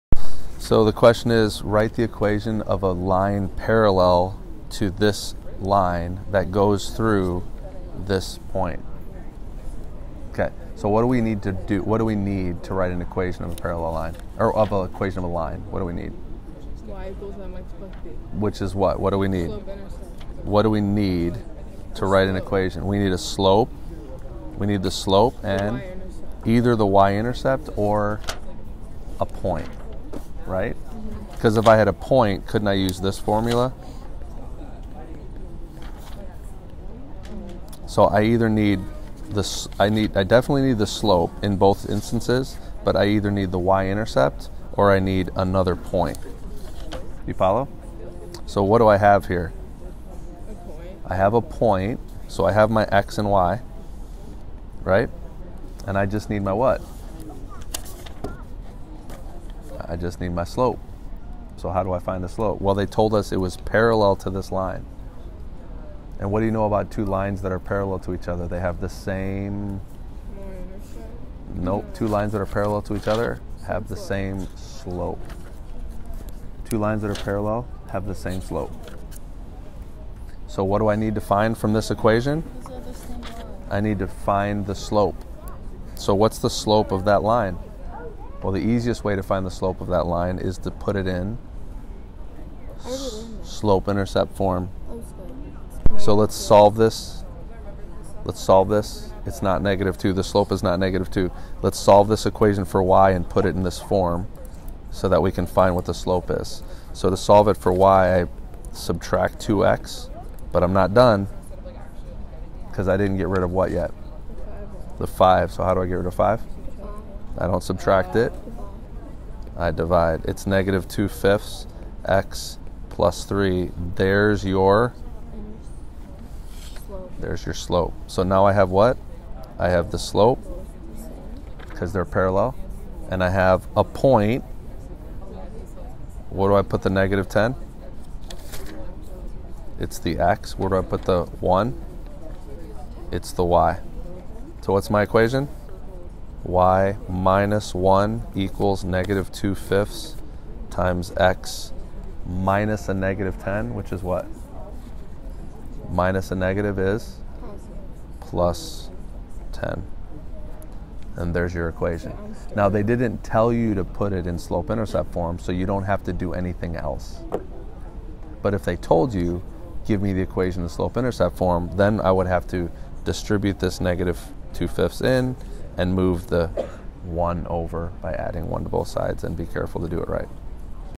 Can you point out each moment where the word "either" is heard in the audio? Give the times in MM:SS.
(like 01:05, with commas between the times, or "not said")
00:26, 00:38, 00:43.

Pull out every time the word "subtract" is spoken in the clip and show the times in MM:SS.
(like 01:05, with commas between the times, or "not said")
01:48, 01:57.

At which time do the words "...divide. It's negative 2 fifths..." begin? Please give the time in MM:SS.
01:59.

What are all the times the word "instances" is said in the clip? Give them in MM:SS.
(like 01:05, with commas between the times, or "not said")
00:41.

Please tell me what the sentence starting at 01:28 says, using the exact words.
Well, the easiest way to find the slope of that line is to put it in slope intercept form.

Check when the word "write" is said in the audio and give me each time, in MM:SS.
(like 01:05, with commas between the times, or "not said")
00:01, 00:12, 00:22.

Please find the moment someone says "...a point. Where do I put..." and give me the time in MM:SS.
02:13.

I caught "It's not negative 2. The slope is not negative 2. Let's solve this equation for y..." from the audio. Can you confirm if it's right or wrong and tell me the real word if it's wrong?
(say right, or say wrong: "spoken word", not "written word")
right.